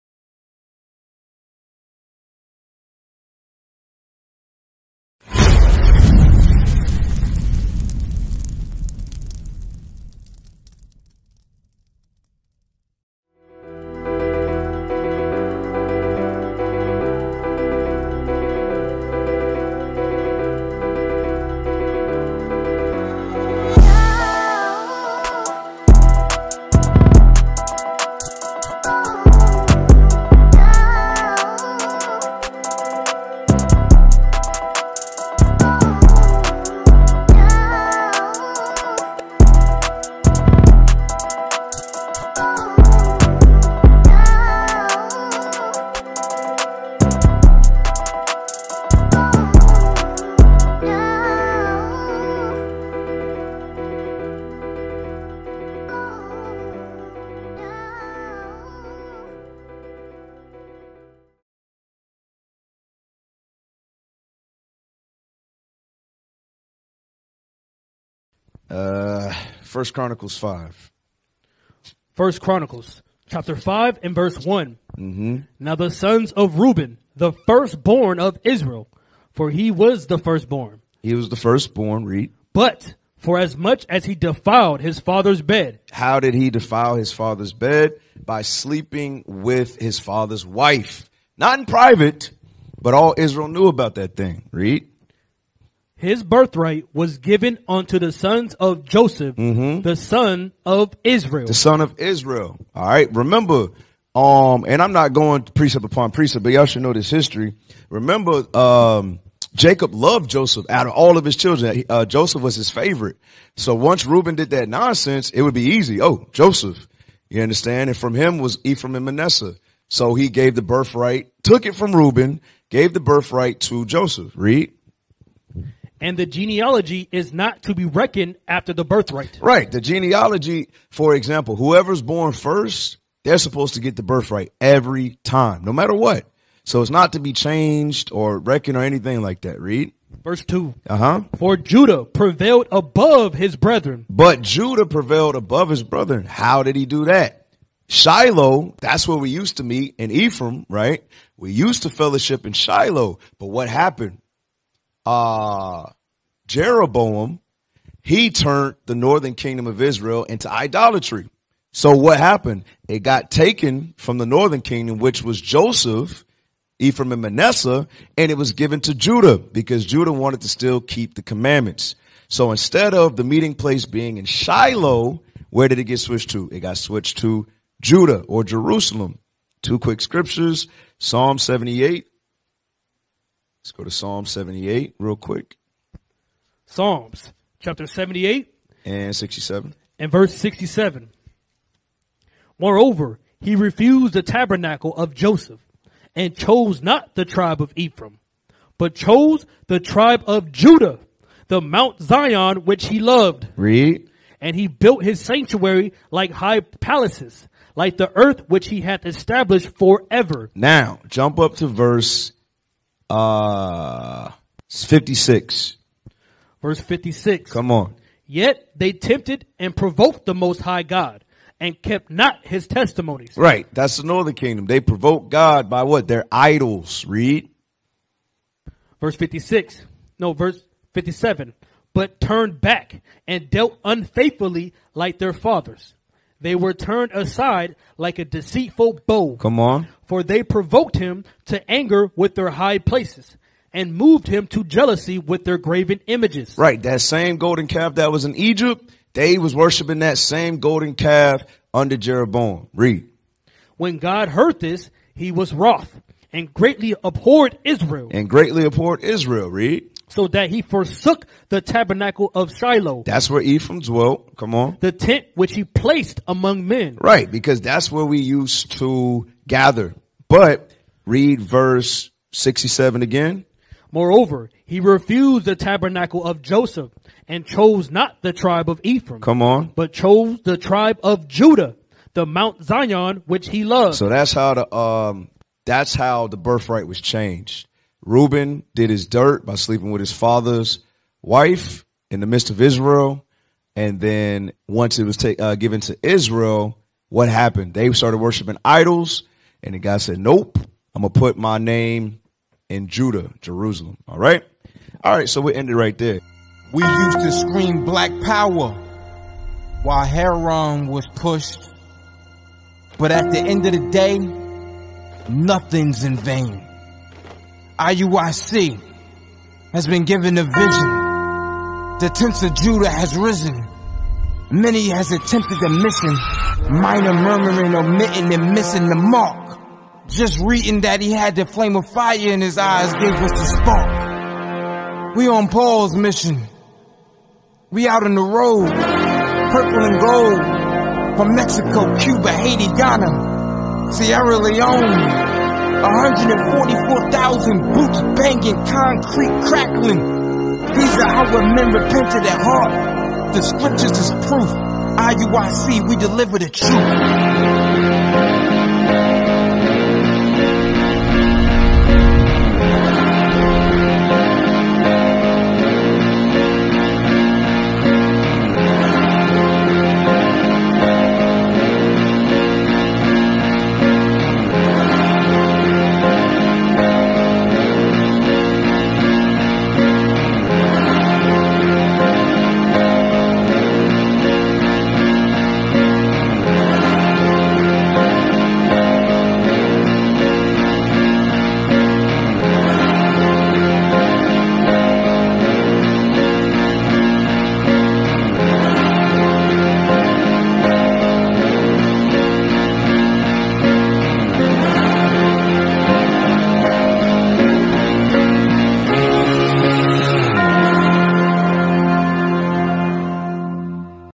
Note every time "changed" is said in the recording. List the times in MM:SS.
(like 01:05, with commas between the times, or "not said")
02:17, 04:47.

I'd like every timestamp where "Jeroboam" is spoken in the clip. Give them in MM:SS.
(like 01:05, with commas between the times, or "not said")
02:36, 04:11.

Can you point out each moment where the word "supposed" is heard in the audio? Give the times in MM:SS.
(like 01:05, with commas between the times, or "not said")
02:13.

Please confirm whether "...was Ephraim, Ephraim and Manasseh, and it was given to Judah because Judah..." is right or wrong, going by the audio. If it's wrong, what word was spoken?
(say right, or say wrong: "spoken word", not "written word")
wrong: "Joseph", not "Ephraim".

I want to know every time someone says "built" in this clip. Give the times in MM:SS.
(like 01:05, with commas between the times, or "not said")
03:24.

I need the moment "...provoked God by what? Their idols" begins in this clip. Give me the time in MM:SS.
03:44.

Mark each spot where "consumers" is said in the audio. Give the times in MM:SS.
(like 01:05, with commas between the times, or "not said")
not said.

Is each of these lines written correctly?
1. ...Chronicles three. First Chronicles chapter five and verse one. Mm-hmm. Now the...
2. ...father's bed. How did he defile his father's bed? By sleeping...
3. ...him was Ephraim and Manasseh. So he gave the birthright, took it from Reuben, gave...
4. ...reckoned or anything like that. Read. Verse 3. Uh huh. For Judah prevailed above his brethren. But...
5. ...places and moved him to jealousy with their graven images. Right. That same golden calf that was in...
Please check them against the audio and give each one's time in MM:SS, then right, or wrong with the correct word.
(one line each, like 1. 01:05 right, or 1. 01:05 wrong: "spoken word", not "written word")
1. 01:09 wrong: "five", not "three"
2. 01:25 right
3. 01:58 right
4. 02:18 wrong: "2", not "3"
5. 04:02 right.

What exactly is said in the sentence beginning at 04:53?
And then once it was ta- uh, given to Israel, what happened?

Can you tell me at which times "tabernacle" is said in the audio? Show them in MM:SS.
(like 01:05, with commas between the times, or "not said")
03:14, 04:21, 04:35.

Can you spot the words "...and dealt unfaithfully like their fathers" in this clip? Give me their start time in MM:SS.
03:53.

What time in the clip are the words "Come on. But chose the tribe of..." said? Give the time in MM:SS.
04:39.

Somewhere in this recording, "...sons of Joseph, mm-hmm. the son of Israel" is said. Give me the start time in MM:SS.
01:38.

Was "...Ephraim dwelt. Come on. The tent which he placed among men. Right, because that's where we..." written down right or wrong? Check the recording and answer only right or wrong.
right.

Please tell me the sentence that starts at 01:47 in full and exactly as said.
Remember, um, Jacob loved Joseph out of all of his children.